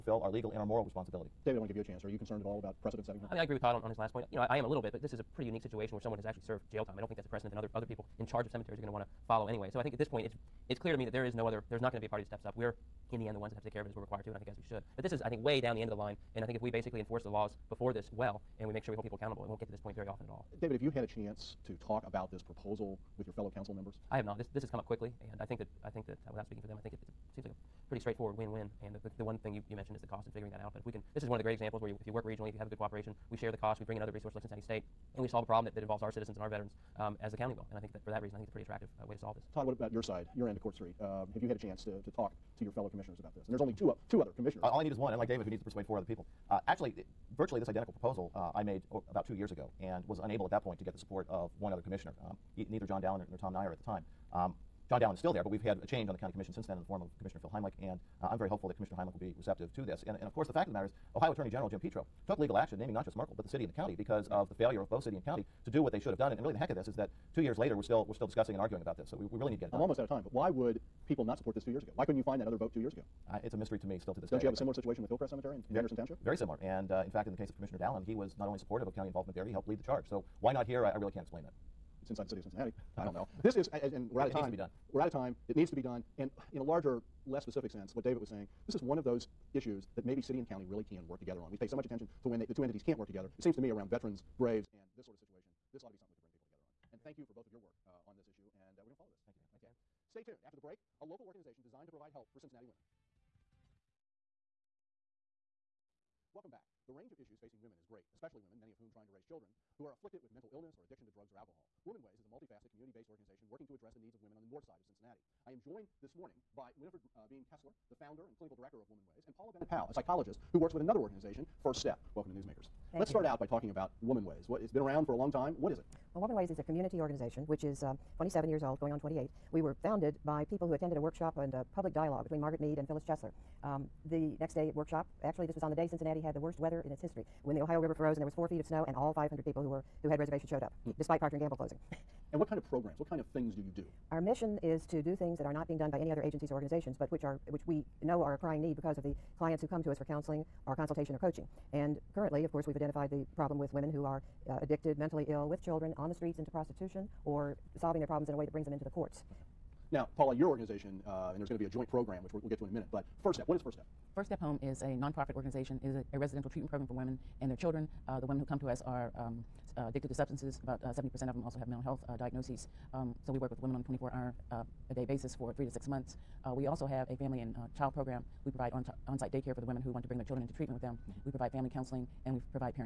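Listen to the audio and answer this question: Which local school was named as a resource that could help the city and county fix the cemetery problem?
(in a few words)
Cincinnati State.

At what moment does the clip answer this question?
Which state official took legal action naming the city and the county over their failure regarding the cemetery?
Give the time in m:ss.
1:01.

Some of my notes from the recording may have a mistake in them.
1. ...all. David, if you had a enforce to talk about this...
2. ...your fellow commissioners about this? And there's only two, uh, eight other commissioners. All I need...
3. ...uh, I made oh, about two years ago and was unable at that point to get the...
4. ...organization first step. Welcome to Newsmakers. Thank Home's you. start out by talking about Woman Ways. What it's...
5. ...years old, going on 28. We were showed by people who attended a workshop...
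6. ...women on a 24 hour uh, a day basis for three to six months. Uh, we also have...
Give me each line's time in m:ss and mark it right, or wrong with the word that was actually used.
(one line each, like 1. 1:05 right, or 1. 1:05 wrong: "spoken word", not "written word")
1. 0:20 wrong: "chance", not "enforce"
2. 0:42 wrong: "two", not "eight"
3. 0:48 right
4. 2:00 wrong: "Let", not "Home"
5. 2:08 wrong: "founded", not "showed"
6. 2:53 right.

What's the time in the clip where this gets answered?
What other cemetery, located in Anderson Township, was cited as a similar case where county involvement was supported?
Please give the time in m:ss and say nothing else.
1:15.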